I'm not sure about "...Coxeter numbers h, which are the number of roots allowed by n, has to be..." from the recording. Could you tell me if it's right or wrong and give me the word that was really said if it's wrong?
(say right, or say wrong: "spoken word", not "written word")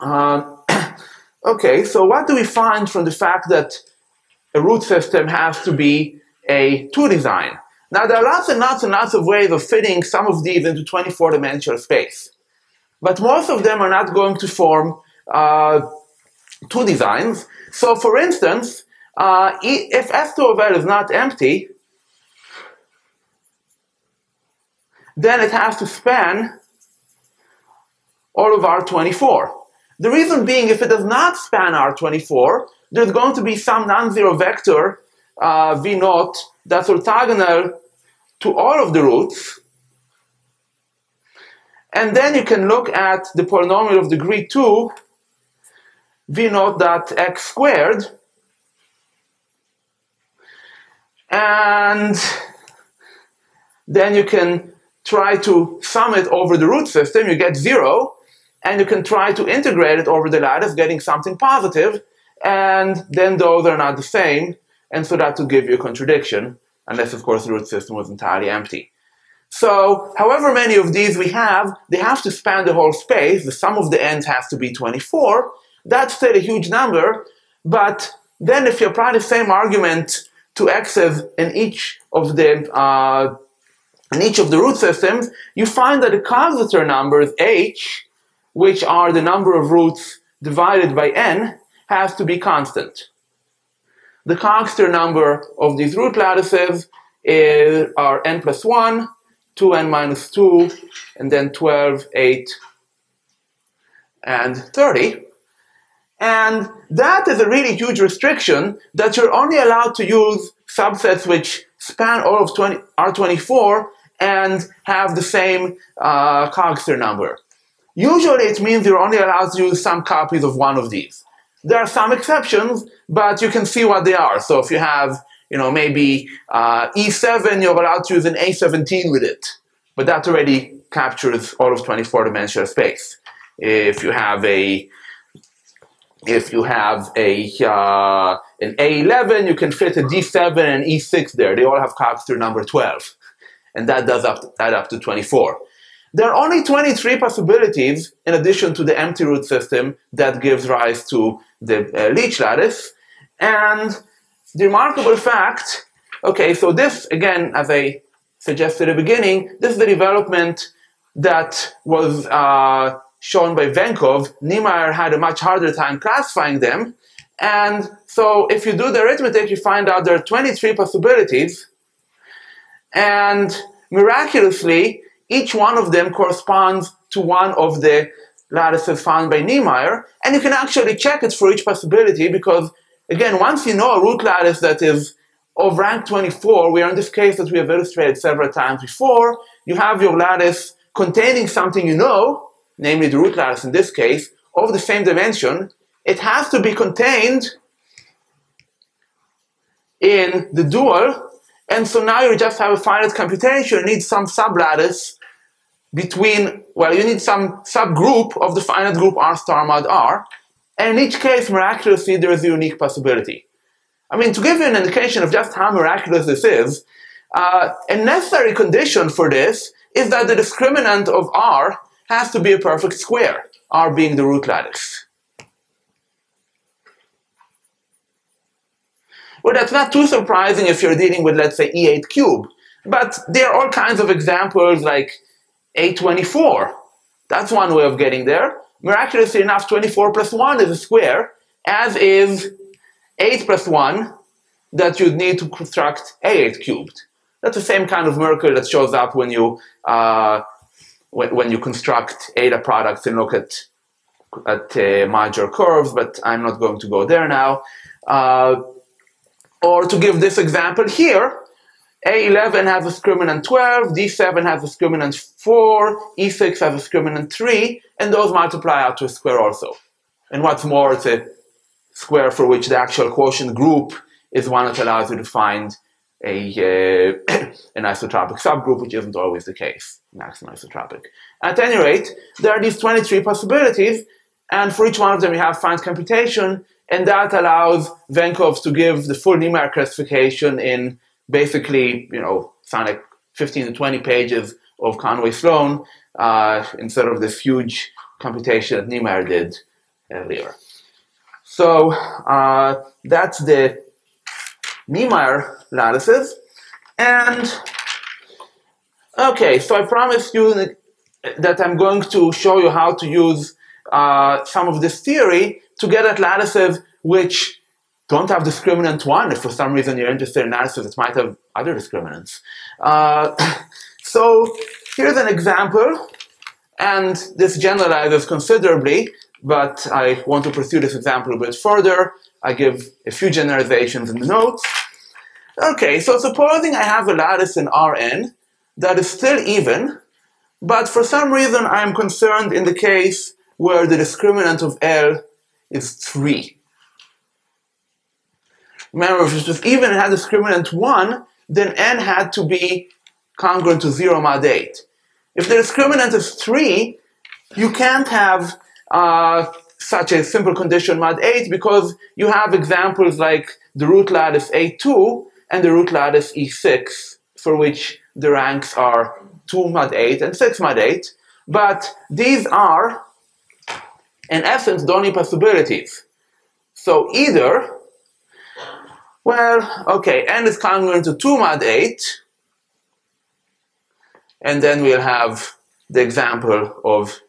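wrong: "divided", not "allowed".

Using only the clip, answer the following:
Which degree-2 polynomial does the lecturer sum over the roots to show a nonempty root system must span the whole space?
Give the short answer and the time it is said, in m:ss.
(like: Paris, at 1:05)
v naught dot x squared, at 0:46.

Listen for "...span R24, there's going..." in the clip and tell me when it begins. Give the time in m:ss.
0:31.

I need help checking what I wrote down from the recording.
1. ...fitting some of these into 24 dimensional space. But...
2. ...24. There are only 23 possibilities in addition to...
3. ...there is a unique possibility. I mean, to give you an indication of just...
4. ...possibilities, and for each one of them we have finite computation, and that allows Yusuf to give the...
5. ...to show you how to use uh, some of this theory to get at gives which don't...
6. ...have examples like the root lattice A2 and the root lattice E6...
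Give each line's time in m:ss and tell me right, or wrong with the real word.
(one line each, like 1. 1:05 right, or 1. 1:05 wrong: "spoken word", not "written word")
1. 0:09 right
2. 2:24 right
3. 3:32 right
4. 4:43 wrong: "Venkovs", not "Yusuf"
5. 5:12 wrong: "lattices", not "gives"
6. 6:02 right.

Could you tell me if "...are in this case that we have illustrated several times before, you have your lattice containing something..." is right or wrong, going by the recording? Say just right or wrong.
right.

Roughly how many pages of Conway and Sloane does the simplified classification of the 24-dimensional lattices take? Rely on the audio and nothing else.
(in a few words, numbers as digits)
15 to 20.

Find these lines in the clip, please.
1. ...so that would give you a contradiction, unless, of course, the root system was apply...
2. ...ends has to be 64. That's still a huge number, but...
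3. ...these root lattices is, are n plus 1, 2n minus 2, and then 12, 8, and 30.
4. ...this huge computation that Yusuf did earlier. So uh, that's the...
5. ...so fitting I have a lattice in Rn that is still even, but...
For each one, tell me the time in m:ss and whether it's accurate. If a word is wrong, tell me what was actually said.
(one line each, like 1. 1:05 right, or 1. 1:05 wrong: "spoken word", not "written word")
1. 1:05 wrong: "entirely", not "apply"
2. 1:14 wrong: "24", not "64"
3. 1:35 right
4. 4:57 wrong: "Niemeier", not "Yusuf"
5. 5:35 wrong: "supposing", not "fitting".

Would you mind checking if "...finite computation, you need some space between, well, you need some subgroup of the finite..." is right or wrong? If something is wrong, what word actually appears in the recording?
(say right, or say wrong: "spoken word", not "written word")
wrong: "sublattice", not "space".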